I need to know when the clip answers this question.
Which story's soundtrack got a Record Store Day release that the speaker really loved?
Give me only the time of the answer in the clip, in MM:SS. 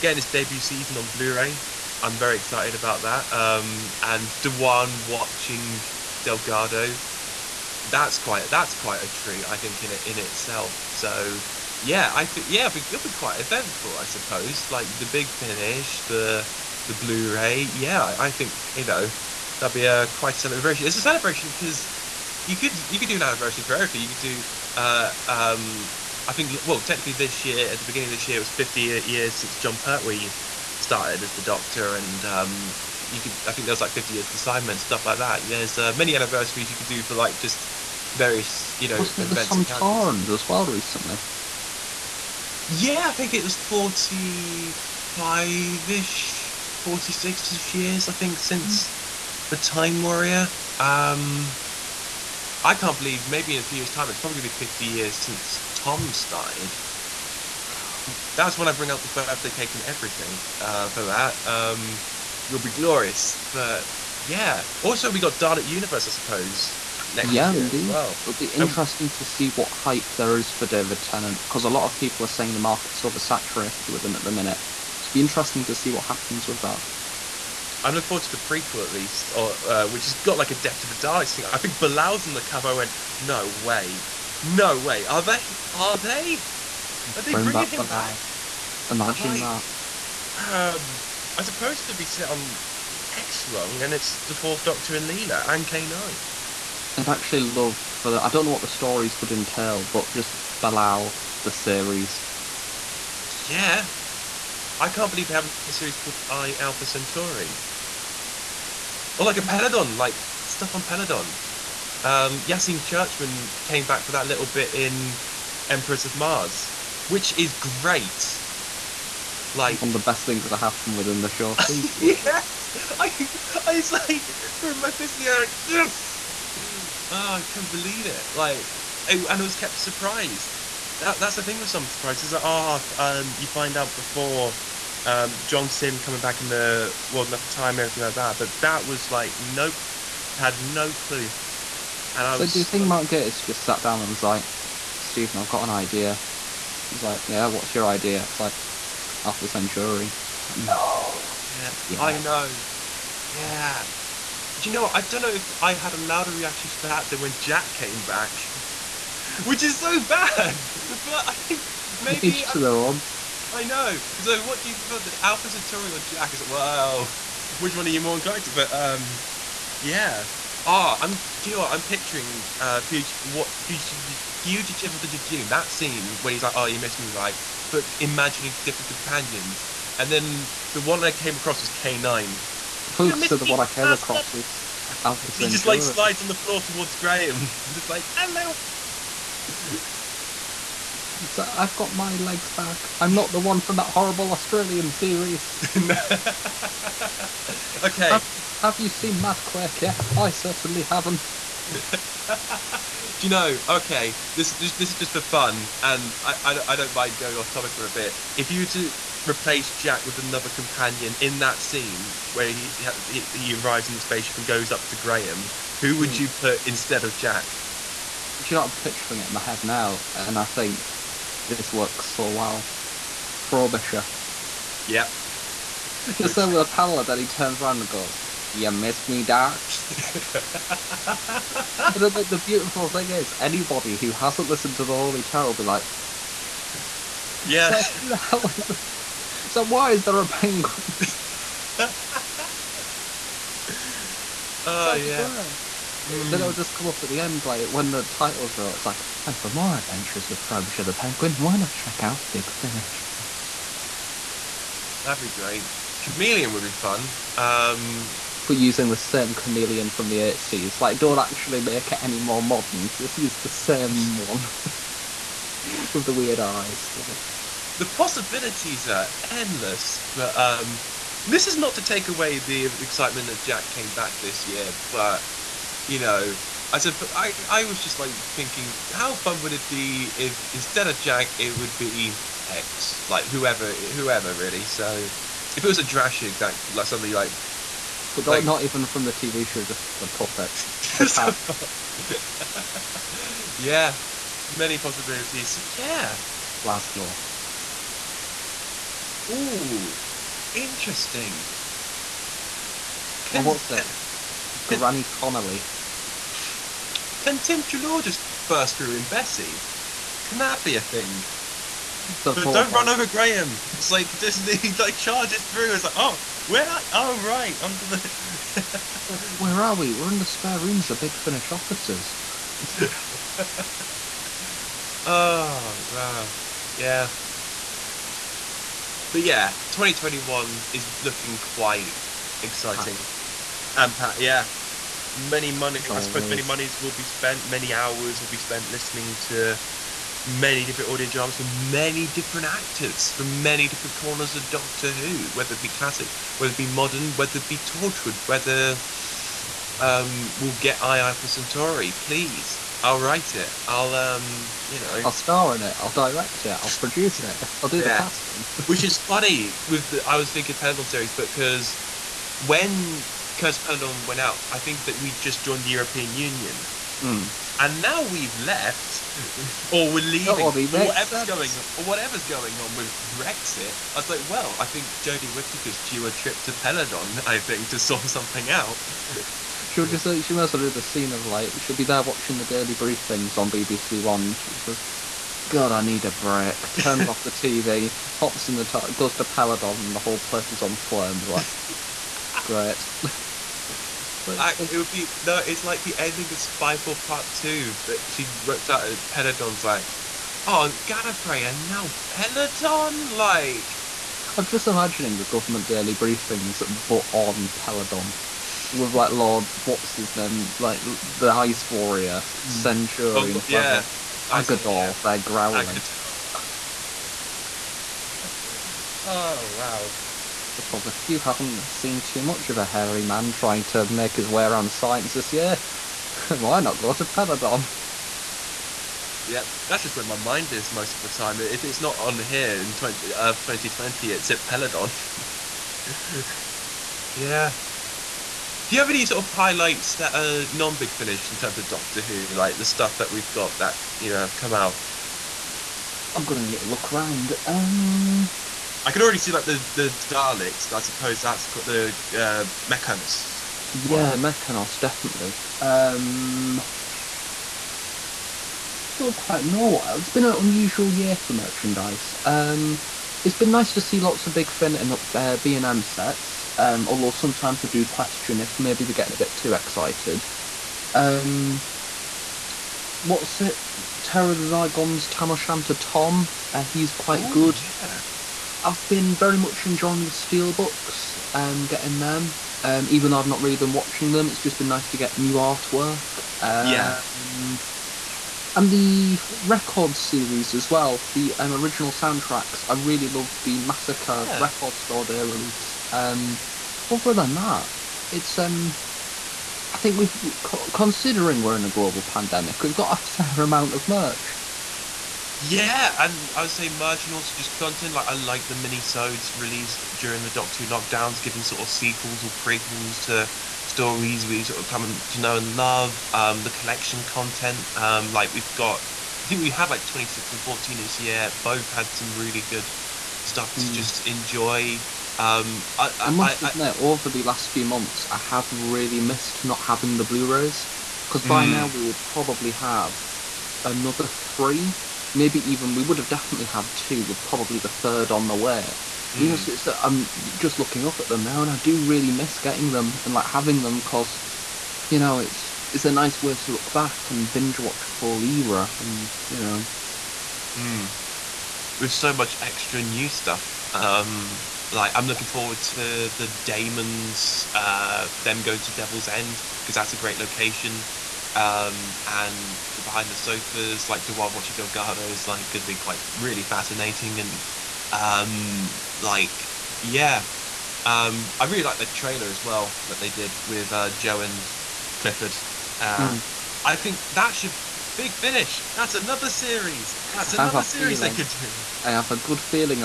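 08:13.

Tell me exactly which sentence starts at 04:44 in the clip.
So, if it was a Drashig that like suddenly like but like, not even from the TV show, just the puppet.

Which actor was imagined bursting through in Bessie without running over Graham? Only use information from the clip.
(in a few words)
Tim Treloar.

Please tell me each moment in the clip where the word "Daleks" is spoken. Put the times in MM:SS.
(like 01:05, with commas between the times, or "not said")
01:05, 01:20, 07:30.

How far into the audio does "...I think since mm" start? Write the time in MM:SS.
00:48.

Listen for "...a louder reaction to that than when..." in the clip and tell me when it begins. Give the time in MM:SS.
02:35.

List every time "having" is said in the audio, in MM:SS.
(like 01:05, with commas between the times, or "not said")
08:49, 09:03.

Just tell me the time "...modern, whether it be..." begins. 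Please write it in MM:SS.
05:46.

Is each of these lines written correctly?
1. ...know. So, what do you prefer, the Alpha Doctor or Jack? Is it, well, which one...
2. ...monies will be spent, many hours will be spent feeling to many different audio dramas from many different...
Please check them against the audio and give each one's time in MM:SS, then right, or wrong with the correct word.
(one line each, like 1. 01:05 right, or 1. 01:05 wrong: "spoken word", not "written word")
1. 02:43 wrong: "Centauri", not "Doctor"
2. 05:36 wrong: "listening", not "feeling".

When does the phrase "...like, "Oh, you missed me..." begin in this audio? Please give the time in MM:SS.
02:56.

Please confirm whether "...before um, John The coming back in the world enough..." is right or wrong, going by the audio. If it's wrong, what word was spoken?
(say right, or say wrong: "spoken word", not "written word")
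wrong: "Simm", not "The".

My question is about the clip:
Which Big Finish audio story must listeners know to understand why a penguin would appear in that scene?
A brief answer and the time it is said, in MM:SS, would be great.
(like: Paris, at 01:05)
The Holy Terror, at 03:54.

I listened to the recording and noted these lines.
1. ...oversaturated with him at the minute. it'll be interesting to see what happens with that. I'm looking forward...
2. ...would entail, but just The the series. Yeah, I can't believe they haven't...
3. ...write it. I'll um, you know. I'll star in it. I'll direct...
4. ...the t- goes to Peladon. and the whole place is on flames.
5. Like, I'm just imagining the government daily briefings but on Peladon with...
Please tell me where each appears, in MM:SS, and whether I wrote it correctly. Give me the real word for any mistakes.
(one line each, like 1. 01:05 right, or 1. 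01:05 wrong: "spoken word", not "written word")
1. 01:13 right
2. 01:39 wrong: "Bellal", not "The"
3. 05:52 right
4. 06:28 right
5. 06:43 right.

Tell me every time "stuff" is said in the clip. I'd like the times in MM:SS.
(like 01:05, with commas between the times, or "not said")
00:34, 01:50, 07:22, 08:43, 09:13.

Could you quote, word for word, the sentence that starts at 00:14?
Like the big finish, the the Blu-ray.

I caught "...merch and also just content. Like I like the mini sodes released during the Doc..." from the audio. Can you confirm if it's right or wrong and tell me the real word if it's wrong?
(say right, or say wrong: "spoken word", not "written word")
right.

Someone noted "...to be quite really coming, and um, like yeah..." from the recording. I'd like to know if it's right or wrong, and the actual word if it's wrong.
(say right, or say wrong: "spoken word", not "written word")
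wrong: "fascinating", not "coming".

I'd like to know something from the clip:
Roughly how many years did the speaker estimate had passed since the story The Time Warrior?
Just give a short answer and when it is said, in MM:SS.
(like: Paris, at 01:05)
45, at 00:43.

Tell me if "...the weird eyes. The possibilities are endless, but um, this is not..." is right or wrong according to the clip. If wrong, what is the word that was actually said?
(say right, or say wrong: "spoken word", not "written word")
right.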